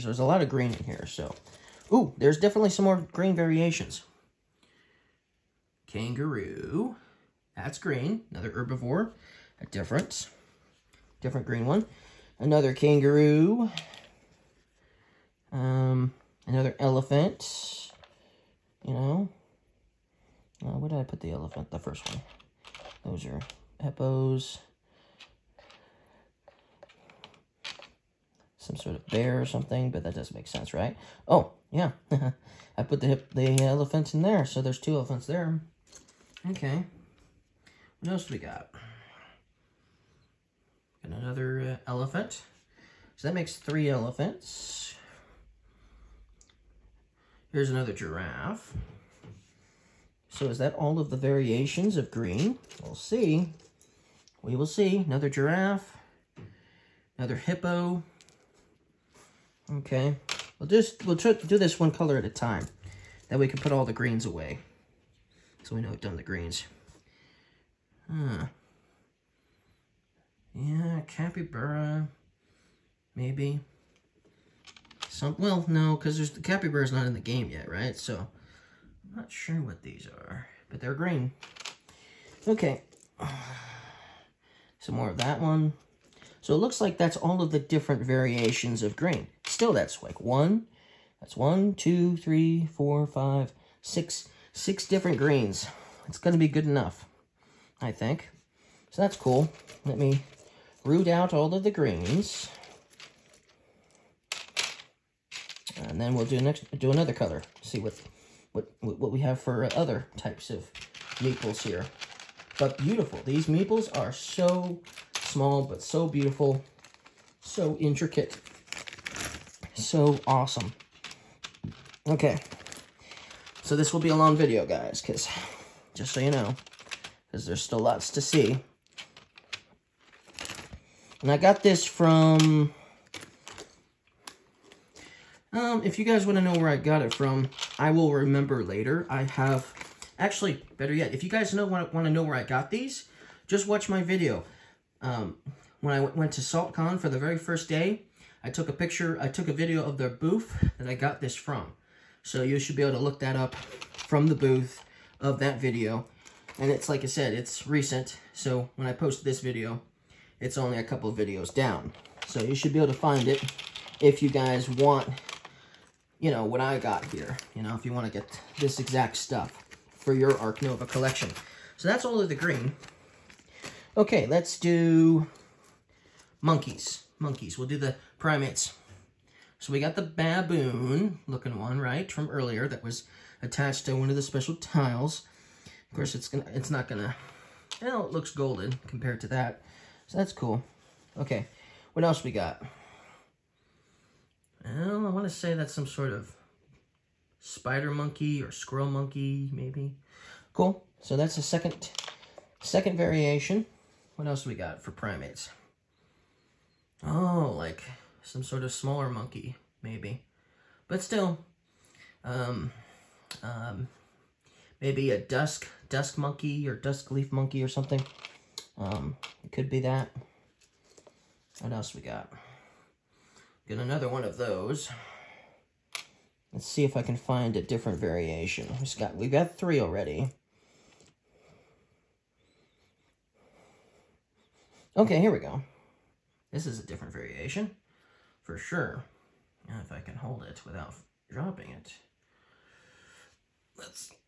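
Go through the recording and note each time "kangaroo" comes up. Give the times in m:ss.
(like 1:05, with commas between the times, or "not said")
0:05, 0:12.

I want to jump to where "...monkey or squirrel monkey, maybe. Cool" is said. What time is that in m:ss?
3:17.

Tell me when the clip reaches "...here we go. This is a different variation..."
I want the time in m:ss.
3:55.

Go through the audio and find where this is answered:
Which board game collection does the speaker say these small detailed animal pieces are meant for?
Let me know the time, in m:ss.
2:50.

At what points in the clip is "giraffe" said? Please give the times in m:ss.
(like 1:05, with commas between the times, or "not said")
0:47, 0:55.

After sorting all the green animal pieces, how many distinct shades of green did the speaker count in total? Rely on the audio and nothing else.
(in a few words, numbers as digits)
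6.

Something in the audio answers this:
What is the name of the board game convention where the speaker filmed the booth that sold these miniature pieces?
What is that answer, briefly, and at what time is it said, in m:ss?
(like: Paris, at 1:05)
SaltCon, at 2:26.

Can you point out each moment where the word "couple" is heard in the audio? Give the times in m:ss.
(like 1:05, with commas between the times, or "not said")
2:40.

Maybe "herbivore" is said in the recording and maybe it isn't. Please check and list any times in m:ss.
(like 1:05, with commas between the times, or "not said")
0:08.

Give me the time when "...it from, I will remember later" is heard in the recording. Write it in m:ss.
2:17.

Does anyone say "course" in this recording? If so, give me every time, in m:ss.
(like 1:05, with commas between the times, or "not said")
3:05.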